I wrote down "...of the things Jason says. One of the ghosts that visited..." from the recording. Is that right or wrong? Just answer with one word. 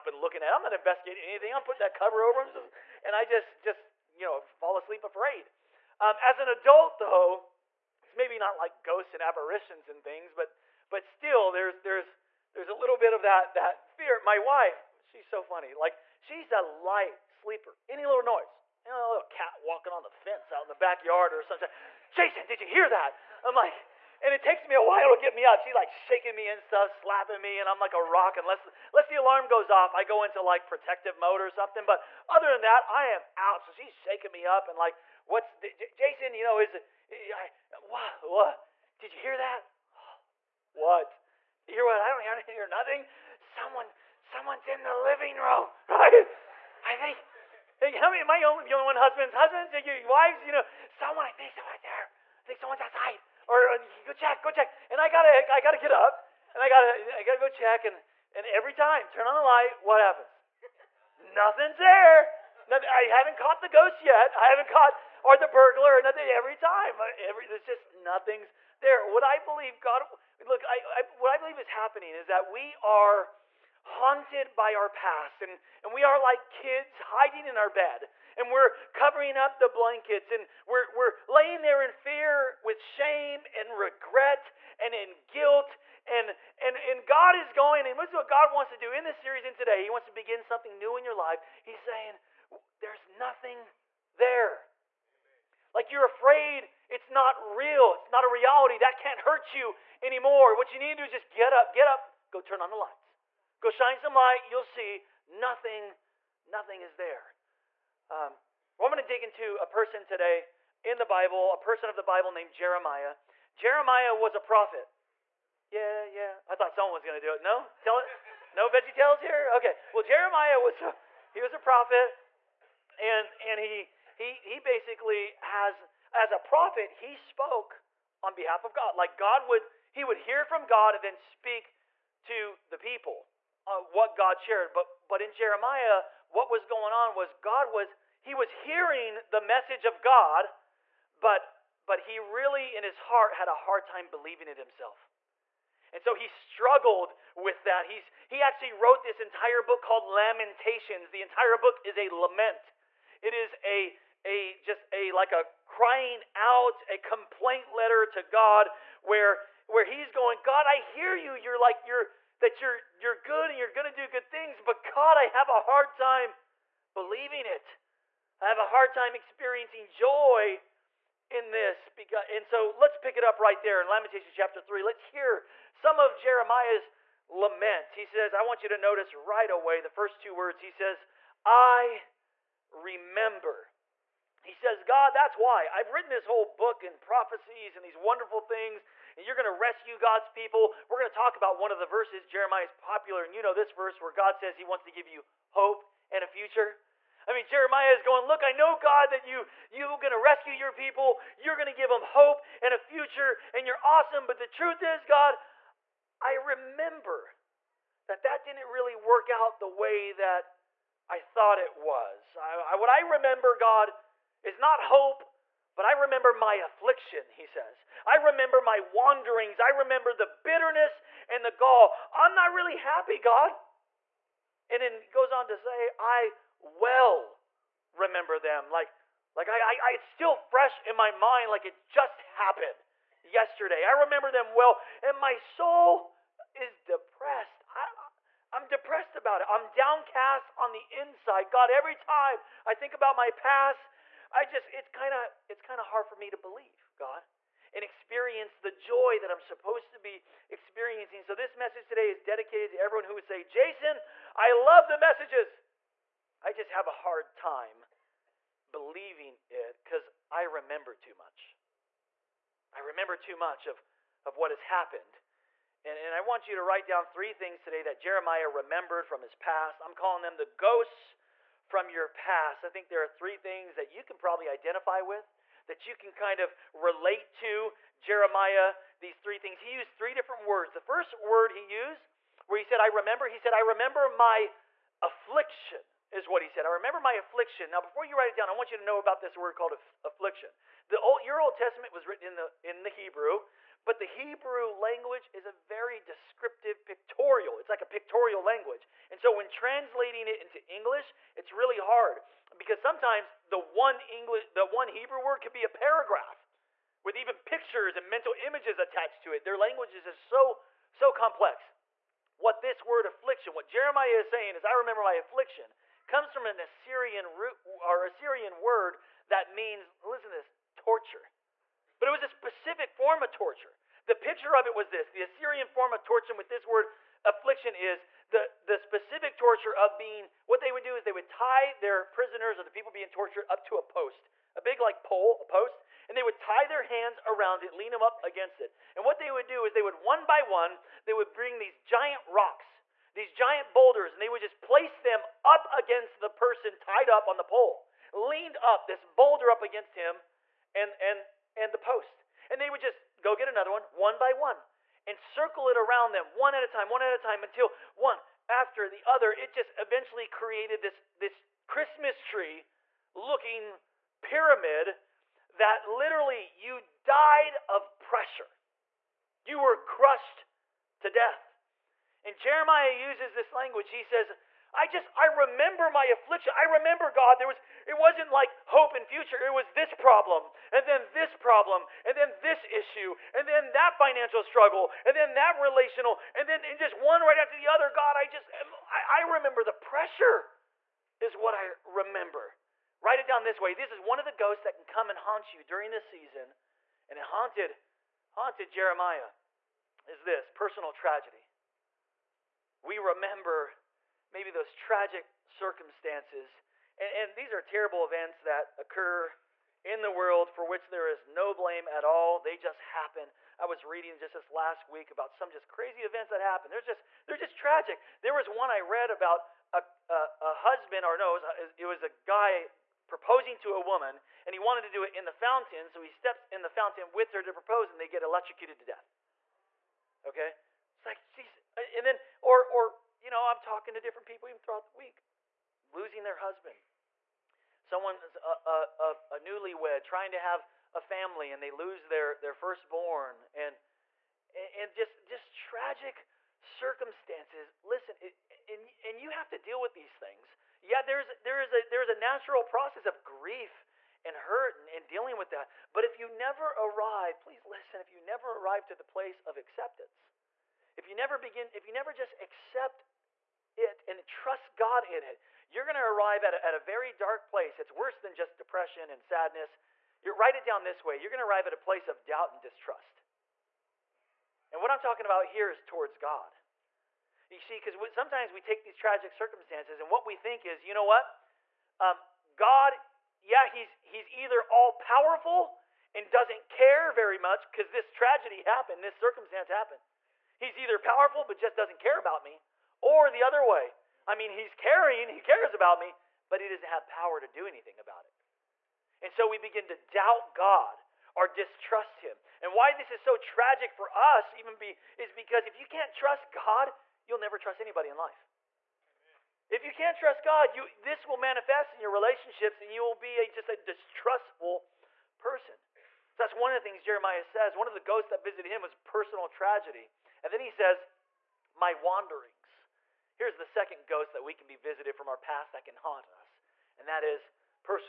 wrong.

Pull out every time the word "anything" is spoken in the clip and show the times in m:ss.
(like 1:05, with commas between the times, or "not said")
0:01, 8:17.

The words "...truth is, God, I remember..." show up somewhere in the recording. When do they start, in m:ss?
3:24.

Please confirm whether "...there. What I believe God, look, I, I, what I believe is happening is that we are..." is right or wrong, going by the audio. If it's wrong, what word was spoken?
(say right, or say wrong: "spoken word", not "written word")
right.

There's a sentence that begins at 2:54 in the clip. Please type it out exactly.
Let's hear some of Jeremiah's lament.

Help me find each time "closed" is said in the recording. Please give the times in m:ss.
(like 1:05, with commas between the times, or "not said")
not said.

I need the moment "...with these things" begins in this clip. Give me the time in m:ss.
7:29.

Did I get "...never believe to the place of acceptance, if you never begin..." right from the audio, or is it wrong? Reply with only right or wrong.
wrong.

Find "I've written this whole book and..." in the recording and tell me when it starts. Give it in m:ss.
3:05.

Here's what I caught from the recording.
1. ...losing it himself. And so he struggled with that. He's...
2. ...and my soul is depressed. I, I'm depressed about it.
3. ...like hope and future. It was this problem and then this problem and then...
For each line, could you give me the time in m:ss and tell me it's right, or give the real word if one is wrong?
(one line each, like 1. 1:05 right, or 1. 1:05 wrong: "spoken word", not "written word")
1. 2:24 wrong: "believing", not "losing"
2. 3:55 right
3. 6:18 right.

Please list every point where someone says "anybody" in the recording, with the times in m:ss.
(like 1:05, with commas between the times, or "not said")
8:27.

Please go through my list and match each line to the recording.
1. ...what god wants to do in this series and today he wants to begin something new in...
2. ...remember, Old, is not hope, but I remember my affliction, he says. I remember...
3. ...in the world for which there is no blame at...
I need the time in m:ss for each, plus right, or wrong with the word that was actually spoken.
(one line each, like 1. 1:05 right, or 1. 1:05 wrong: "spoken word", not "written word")
1. 1:28 right
2. 3:33 wrong: "God", not "Old"
3. 6:49 right.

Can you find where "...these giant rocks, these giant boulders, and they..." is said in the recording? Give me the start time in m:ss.
5:41.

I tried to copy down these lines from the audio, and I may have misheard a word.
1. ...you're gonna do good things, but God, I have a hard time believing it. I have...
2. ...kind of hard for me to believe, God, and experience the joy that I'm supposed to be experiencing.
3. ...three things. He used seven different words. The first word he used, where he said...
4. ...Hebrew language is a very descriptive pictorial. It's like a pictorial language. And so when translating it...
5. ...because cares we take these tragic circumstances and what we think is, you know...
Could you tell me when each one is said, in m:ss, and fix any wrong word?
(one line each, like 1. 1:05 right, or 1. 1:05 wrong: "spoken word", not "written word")
1. 2:43 right
2. 4:05 right
3. 4:39 wrong: "three", not "seven"
4. 4:54 right
5. 7:57 wrong: "sometimes", not "cares".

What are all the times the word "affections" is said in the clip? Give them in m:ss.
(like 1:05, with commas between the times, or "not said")
not said.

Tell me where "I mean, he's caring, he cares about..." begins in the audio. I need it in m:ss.
8:14.